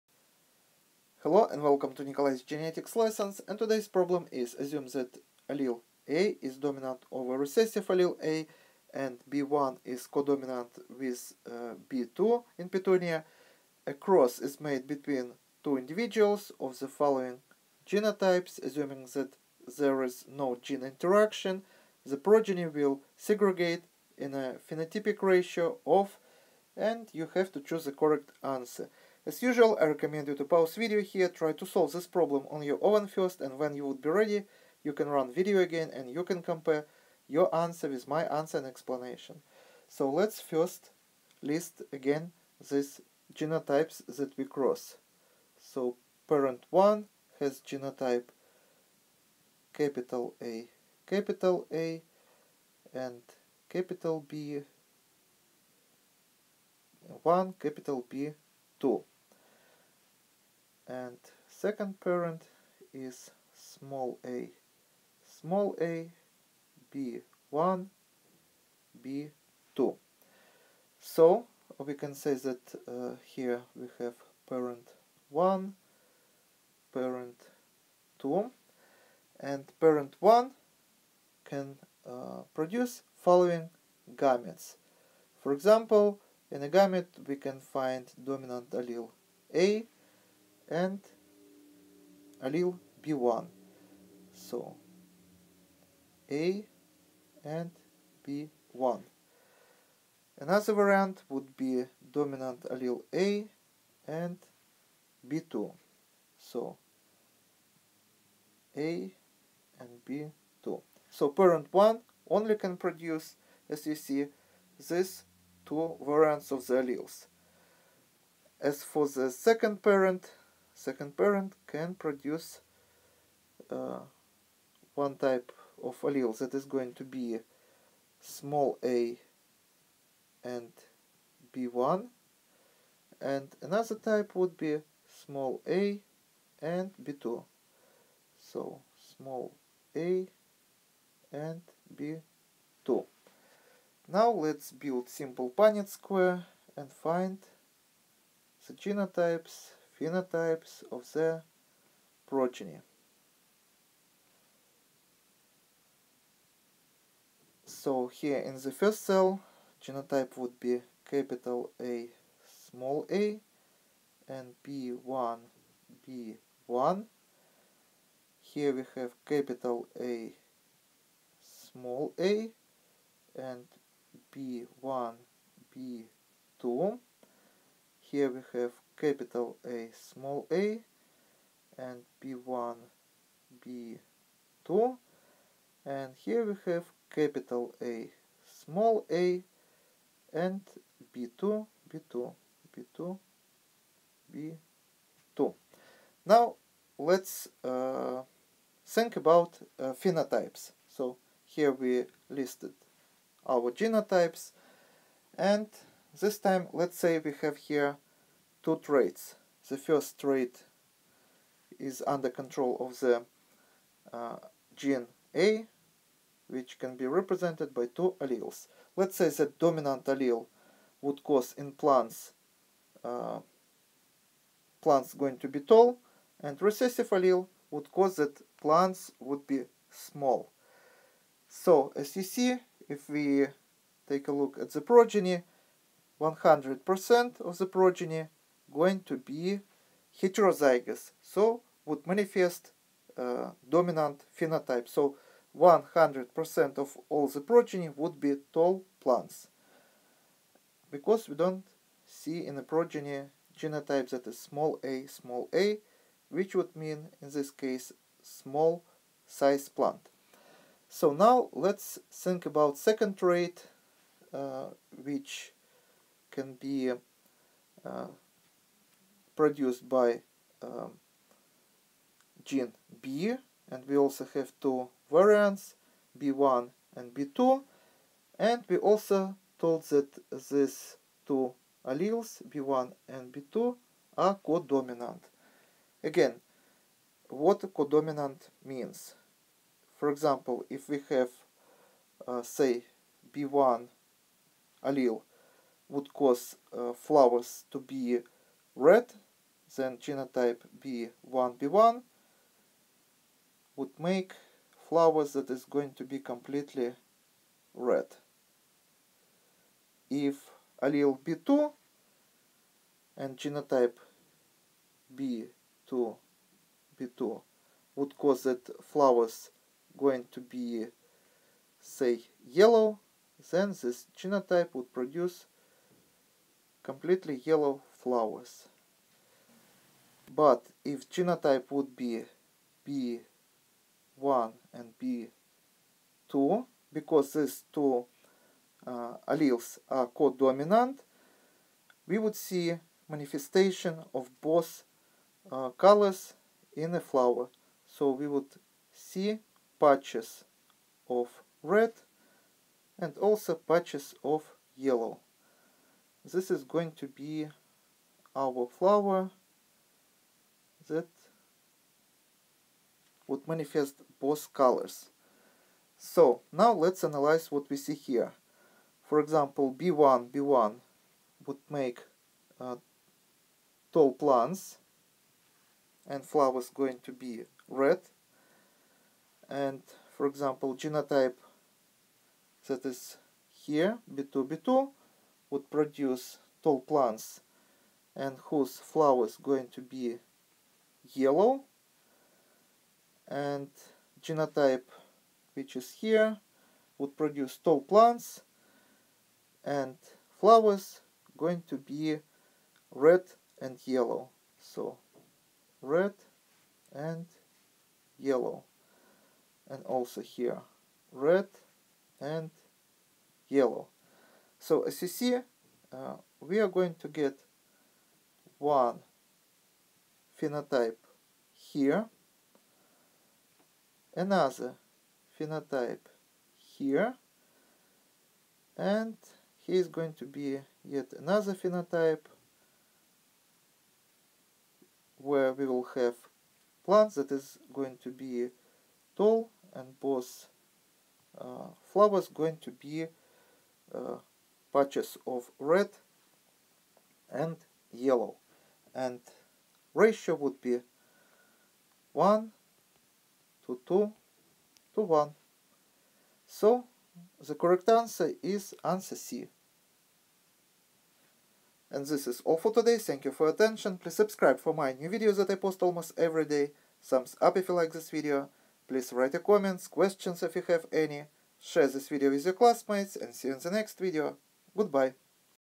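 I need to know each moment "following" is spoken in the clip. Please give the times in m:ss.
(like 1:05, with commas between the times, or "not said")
0:16, 1:23.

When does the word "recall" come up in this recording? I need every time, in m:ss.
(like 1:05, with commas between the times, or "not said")
not said.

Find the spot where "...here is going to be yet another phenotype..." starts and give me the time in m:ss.
7:09.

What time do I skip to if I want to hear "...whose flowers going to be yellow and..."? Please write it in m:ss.
6:28.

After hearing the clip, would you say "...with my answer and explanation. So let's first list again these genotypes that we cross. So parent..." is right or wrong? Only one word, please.
right.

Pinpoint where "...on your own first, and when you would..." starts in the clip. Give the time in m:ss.
0:32.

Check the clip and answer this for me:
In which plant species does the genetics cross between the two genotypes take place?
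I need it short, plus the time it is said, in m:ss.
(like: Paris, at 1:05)
Petunia, at 0:12.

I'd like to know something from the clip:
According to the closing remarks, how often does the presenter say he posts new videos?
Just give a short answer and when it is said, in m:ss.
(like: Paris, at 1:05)
almost every day, at 7:45.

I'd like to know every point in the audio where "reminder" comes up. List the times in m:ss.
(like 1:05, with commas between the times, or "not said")
not said.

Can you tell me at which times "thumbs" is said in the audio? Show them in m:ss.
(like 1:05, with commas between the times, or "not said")
7:47.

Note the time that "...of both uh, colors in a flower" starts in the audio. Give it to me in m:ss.
5:44.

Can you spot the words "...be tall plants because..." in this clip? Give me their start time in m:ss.
4:08.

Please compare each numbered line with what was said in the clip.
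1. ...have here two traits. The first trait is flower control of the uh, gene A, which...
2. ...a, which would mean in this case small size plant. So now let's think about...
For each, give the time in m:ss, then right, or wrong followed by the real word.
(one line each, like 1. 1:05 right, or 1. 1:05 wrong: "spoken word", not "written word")
1. 3:27 wrong: "under", not "flower"
2. 4:15 right.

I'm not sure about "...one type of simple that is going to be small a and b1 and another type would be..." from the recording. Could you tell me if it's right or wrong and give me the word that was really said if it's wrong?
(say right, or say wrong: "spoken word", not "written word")
wrong: "allele", not "simple".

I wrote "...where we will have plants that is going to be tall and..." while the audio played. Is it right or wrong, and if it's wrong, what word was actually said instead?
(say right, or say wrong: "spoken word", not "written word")
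right.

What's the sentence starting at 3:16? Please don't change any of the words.
Now let's uh, think about uh, phenotypes.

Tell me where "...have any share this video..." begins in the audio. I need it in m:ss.
7:50.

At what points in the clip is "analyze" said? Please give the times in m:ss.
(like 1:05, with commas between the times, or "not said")
6:07.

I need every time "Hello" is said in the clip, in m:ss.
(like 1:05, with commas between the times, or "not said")
0:01.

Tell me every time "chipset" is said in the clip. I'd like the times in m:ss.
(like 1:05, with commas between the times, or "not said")
not said.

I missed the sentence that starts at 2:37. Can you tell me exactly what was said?
So here in the first cell, genotype would be capital A, small a, and B1, B1.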